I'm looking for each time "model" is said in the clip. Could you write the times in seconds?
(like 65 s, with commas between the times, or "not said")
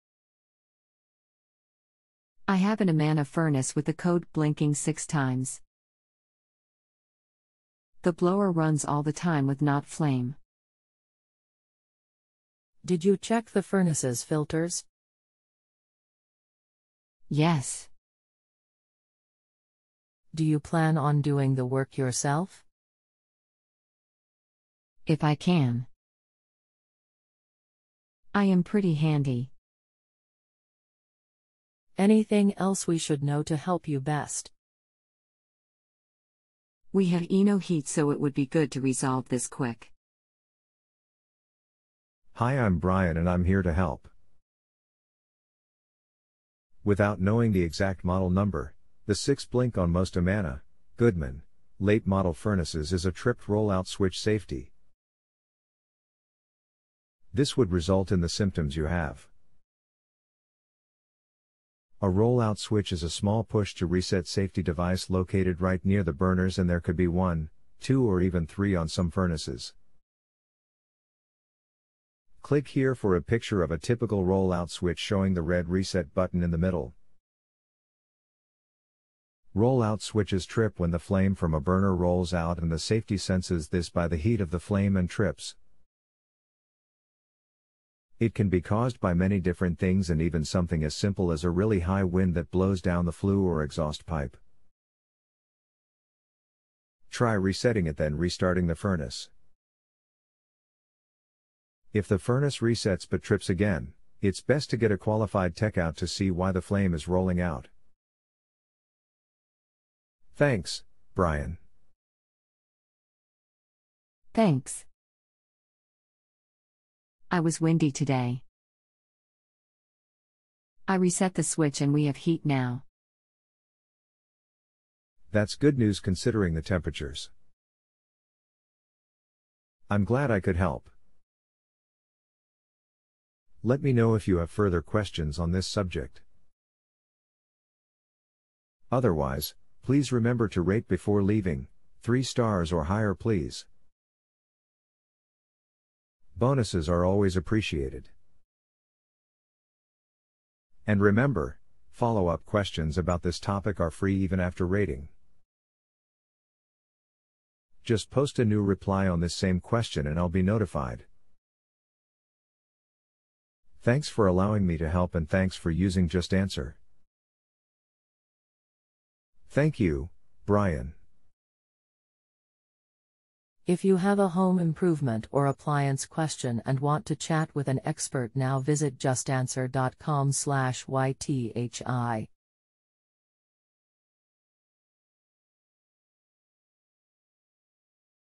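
48 s, 52 s.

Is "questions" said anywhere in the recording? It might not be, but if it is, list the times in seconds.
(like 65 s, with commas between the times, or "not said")
134 s, 152 s, 159 s, 176 s.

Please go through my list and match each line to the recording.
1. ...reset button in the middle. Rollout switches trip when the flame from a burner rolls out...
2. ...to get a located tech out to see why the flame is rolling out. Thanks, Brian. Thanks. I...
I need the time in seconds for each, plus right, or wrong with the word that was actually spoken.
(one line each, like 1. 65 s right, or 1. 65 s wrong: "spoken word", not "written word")
1. 75 s right
2. 104 s wrong: "qualified", not "located".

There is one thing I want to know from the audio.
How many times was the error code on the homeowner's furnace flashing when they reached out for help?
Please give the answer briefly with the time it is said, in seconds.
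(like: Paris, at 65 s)
6, at 4 s.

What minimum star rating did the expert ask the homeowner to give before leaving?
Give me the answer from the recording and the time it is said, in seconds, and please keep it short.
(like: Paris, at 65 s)
3 stars, at 142 s.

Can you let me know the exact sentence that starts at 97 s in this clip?
Try resetting it then restarting the furnace.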